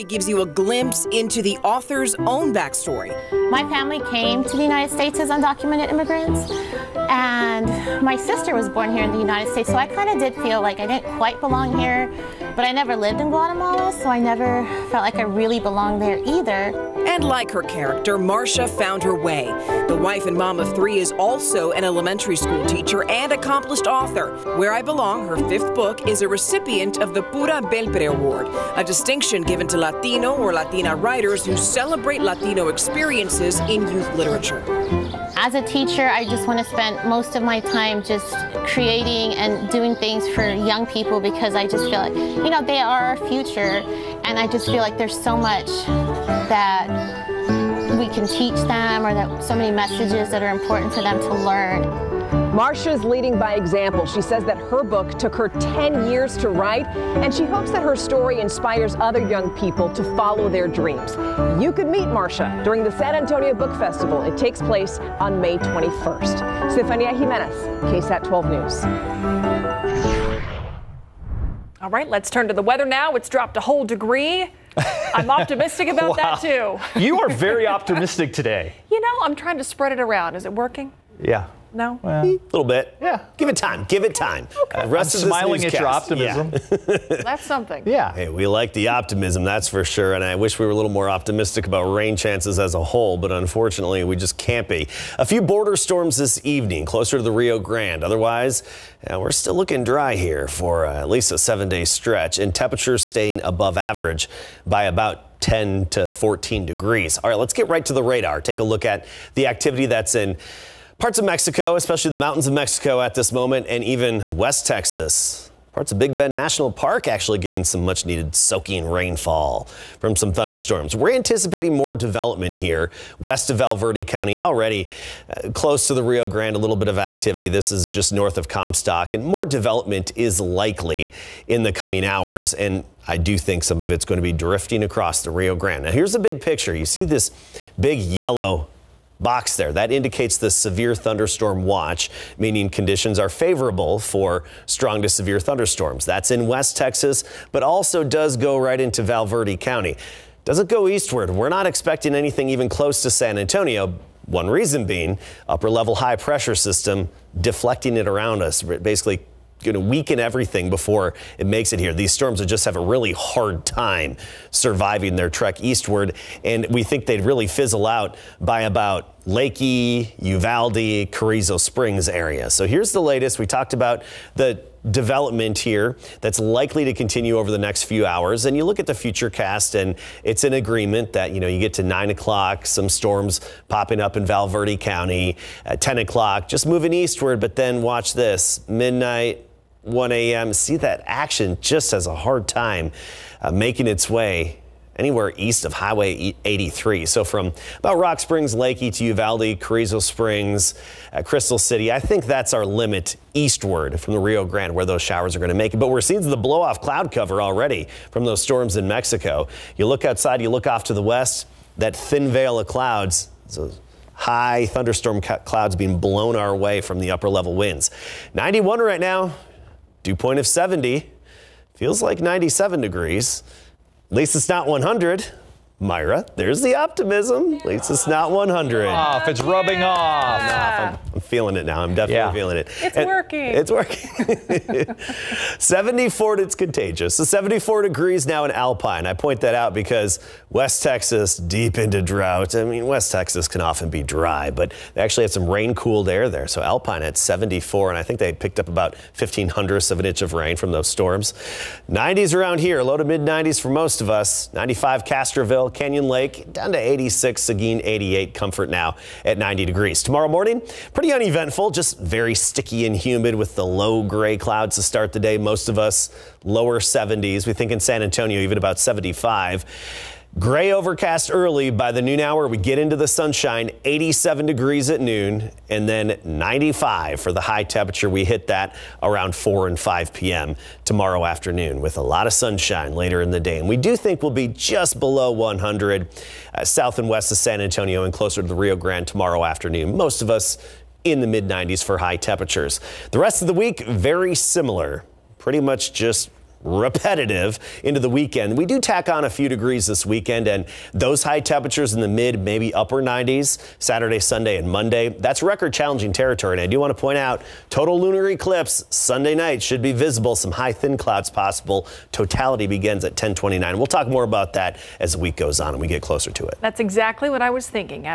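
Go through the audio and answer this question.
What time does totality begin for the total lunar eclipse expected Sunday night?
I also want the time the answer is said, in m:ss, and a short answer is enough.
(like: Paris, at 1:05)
10:29, at 5:13.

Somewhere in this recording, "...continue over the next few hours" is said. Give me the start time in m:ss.
2:56.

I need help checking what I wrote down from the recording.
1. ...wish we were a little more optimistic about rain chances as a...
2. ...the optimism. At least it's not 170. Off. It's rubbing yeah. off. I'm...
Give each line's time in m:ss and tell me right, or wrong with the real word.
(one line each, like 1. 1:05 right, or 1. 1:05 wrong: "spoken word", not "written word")
1. 1:30 right
2. 3:46 wrong: "100", not "170".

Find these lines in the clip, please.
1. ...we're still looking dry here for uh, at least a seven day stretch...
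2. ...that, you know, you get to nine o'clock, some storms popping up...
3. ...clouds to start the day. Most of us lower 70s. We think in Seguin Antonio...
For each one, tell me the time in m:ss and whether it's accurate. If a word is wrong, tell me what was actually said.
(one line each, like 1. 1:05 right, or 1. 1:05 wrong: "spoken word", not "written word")
1. 1:39 right
2. 3:01 right
3. 4:24 wrong: "San", not "Seguin".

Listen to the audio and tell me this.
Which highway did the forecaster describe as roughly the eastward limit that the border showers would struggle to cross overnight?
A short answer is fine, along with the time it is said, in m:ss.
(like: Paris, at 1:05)
Highway 83, at 3:15.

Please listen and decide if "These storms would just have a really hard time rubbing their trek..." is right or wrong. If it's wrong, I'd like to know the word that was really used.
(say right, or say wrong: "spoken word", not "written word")
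wrong: "surviving", not "rubbing".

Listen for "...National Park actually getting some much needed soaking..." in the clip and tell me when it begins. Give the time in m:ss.
1:56.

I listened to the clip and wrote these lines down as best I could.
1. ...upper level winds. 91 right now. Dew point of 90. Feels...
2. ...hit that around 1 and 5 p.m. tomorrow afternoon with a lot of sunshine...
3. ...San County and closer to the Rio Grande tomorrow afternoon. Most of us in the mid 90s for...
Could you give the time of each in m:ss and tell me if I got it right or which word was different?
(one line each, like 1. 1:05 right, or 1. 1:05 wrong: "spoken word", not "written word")
1. 3:37 wrong: "70", not "90"
2. 4:38 wrong: "4", not "1"
3. 4:47 wrong: "Antonio", not "County".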